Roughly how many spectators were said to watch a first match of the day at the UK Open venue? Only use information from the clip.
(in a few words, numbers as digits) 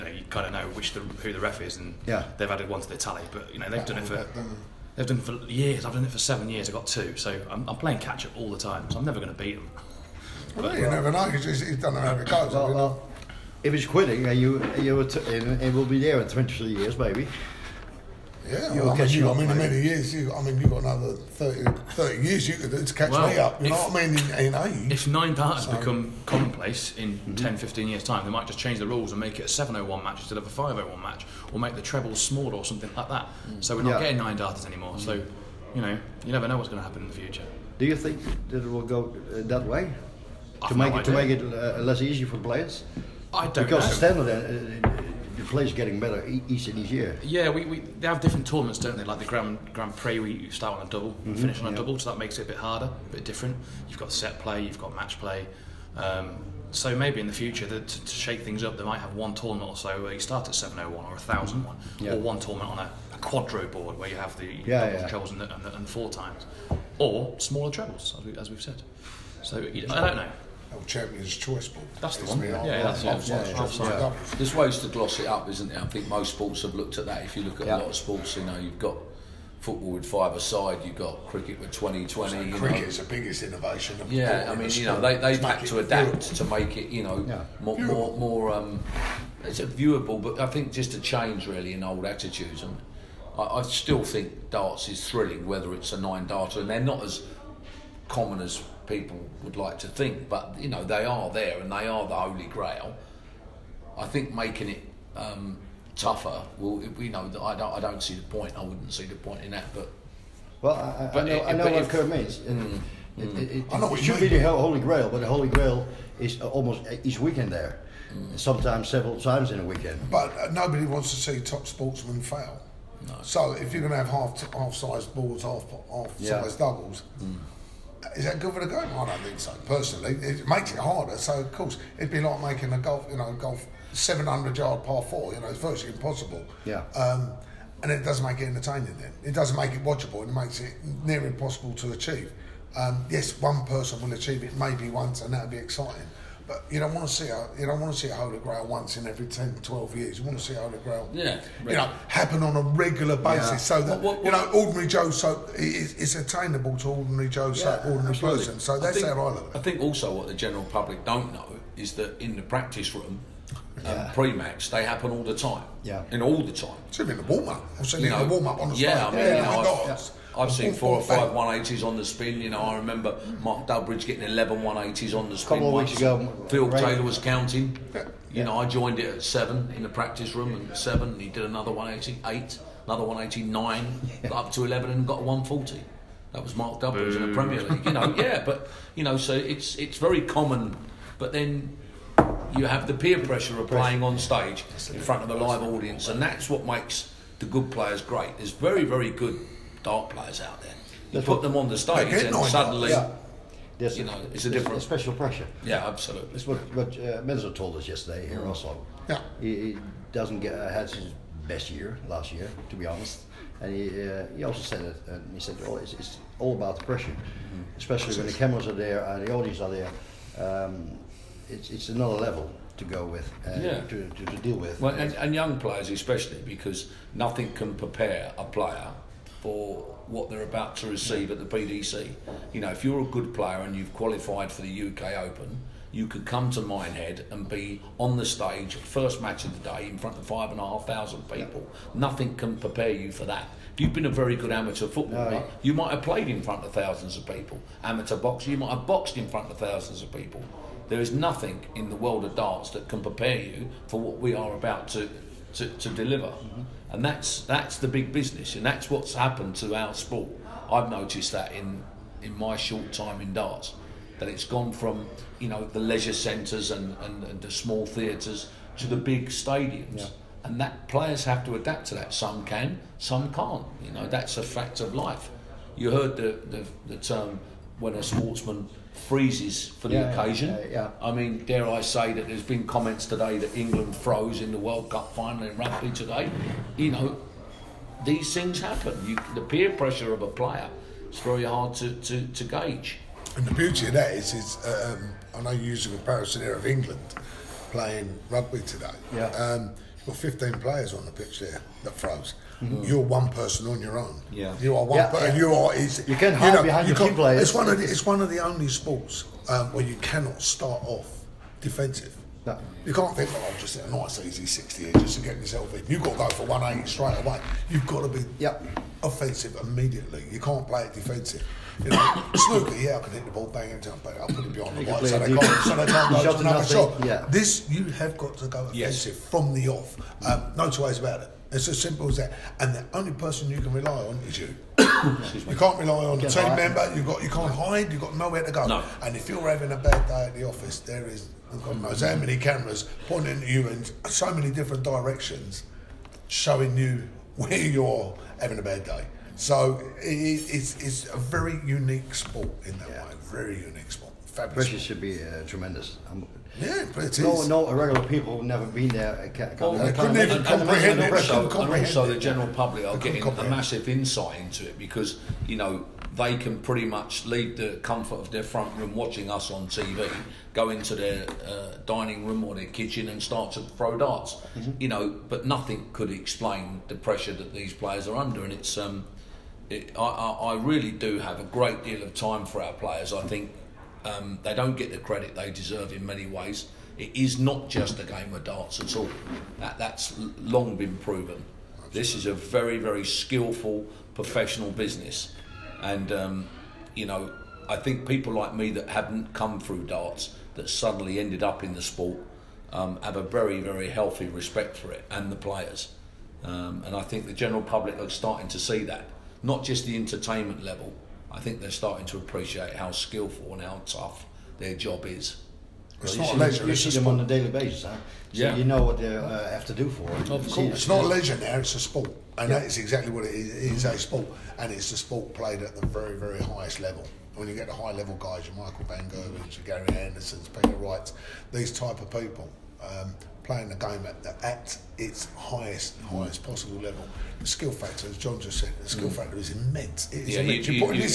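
5,500.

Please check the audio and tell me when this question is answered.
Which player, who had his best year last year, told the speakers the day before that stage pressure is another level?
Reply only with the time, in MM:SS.
03:27.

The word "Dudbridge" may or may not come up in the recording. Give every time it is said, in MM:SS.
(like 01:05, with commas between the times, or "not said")
02:53, 03:06.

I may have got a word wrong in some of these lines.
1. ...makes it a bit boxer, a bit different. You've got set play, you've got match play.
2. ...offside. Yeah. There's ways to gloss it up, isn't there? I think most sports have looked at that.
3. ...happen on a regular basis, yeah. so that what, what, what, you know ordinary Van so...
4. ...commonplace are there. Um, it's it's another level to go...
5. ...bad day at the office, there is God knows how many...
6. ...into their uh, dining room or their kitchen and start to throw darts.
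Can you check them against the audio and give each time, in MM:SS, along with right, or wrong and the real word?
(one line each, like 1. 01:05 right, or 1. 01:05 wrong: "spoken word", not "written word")
1. 00:52 wrong: "harder", not "boxer"
2. 01:13 right
3. 02:32 wrong: "Joe", not "Van"
4. 03:39 wrong: "audience", not "commonplace"
5. 05:39 right
6. 06:10 right.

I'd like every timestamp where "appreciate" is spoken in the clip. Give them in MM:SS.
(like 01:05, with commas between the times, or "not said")
06:52.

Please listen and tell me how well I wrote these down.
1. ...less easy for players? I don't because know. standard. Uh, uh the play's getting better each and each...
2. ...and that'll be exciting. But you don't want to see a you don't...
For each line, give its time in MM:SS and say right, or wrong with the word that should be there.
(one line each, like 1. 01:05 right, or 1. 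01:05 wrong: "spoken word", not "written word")
1. 00:41 right
2. 02:25 right.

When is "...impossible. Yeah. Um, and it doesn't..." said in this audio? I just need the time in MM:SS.
02:15.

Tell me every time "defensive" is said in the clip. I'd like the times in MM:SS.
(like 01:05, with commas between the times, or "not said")
05:11, 05:20.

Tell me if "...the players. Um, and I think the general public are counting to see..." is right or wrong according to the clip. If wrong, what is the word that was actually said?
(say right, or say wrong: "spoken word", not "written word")
wrong: "starting", not "counting".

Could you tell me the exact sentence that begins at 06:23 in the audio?
I think um, they don't get the credit they deserve in many ways.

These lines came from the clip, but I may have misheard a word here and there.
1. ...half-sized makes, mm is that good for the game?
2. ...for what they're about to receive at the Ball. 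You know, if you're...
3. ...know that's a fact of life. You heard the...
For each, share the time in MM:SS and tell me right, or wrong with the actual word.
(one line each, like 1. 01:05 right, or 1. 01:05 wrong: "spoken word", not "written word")
1. 02:05 wrong: "doubles", not "makes"
2. 03:49 wrong: "PDC", not "Ball"
3. 04:33 right.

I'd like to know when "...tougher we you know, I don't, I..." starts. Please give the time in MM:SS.
01:45.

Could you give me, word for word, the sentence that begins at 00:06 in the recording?
I got two, so I'm, I'm playing catch up all the time.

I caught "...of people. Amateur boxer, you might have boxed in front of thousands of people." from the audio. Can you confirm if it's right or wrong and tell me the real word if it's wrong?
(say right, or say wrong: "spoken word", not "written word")
right.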